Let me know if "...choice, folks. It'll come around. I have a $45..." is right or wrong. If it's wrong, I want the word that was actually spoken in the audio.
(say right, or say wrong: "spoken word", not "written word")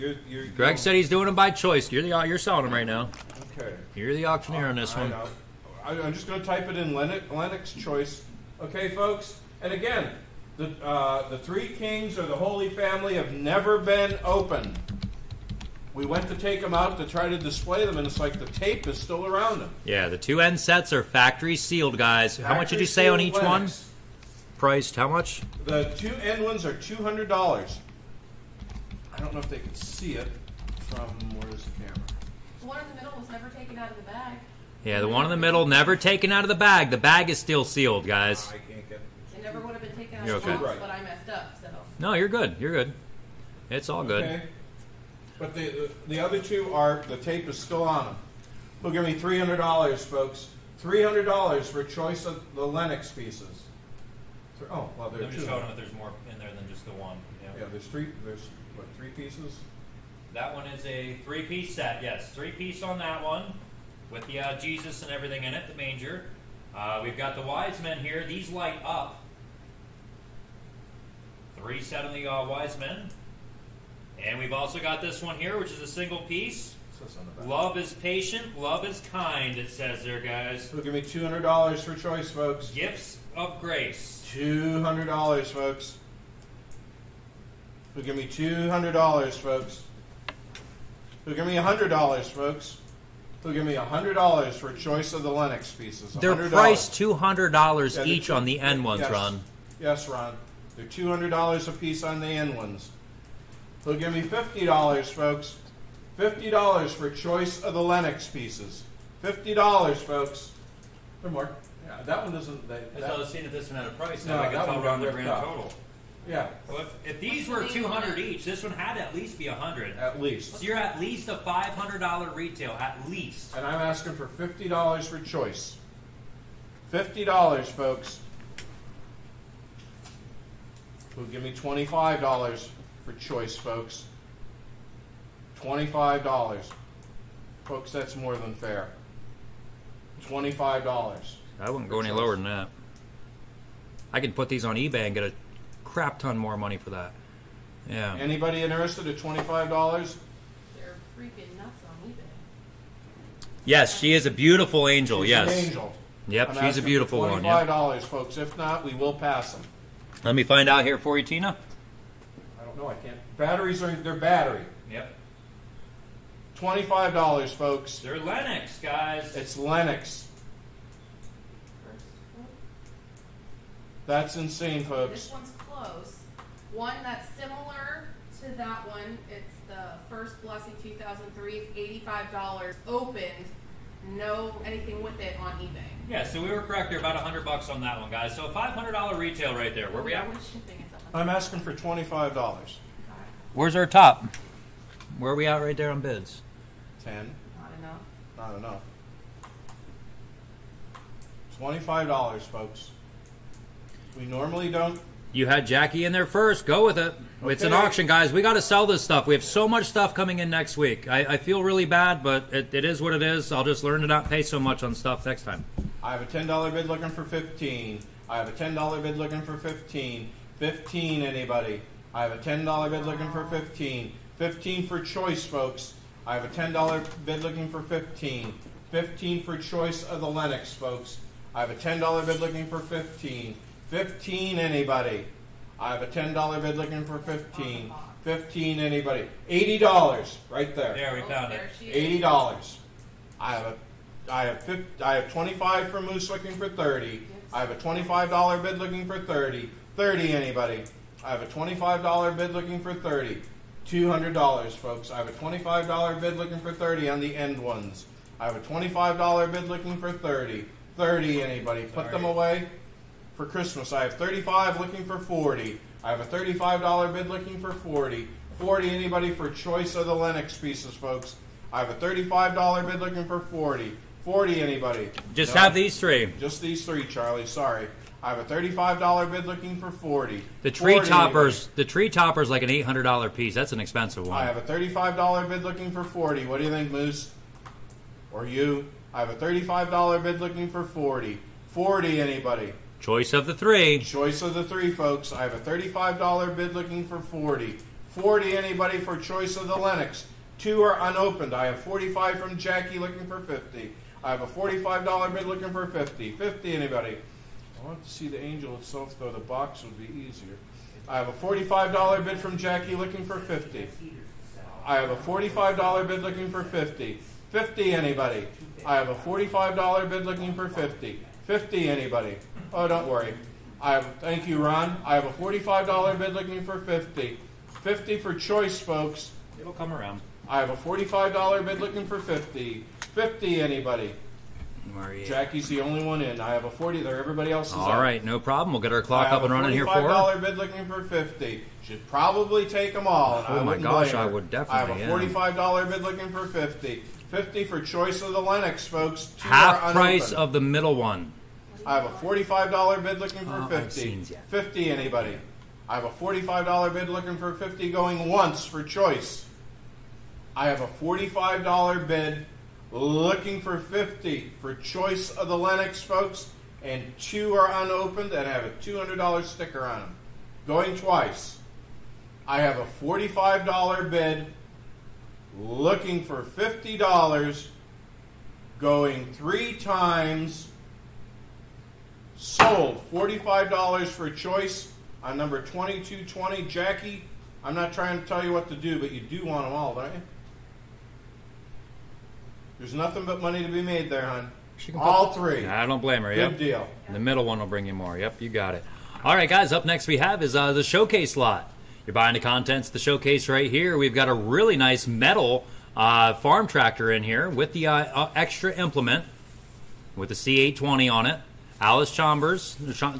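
right.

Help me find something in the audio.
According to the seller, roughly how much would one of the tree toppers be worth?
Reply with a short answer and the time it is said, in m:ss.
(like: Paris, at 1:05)
$800, at 4:42.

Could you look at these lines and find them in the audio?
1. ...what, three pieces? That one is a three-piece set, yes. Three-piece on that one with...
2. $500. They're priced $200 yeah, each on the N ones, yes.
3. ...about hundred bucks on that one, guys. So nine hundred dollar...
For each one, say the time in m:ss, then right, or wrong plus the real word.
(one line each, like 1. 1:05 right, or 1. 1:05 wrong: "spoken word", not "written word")
1. 0:58 right
2. 1:36 wrong: "100", not "500"
3. 3:07 wrong: "five", not "nine".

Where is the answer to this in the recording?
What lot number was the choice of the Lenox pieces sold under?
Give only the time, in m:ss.
6:25.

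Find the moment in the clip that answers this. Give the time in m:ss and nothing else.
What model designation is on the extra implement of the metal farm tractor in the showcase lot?
6:50.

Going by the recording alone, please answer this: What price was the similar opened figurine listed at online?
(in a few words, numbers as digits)
$85.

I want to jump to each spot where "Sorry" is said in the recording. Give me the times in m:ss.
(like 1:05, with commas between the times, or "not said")
4:21, 4:37.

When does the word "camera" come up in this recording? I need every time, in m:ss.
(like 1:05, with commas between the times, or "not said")
0:31.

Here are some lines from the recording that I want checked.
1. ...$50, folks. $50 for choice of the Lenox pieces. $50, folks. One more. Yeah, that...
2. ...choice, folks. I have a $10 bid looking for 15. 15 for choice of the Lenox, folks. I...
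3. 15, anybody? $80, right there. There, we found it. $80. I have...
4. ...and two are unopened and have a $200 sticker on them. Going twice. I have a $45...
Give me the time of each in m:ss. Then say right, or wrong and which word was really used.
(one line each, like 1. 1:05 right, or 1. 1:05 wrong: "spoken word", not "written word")
1. 1:44 right
2. 3:45 right
3. 3:58 right
4. 6:06 right.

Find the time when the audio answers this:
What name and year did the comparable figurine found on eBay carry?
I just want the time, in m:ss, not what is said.
3:00.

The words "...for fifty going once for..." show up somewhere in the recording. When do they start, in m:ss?
5:57.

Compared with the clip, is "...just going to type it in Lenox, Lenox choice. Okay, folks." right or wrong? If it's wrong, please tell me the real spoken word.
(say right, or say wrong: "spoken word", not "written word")
right.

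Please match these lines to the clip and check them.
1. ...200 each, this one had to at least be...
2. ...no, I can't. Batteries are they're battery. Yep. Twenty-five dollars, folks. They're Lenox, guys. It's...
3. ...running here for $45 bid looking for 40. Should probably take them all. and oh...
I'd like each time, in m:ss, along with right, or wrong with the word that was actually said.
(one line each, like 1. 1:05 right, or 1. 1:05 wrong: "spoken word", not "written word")
1. 1:57 right
2. 2:42 right
3. 5:39 wrong: "50", not "40".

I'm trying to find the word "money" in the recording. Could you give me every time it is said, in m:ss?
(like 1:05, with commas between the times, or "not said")
2:26, 6:33.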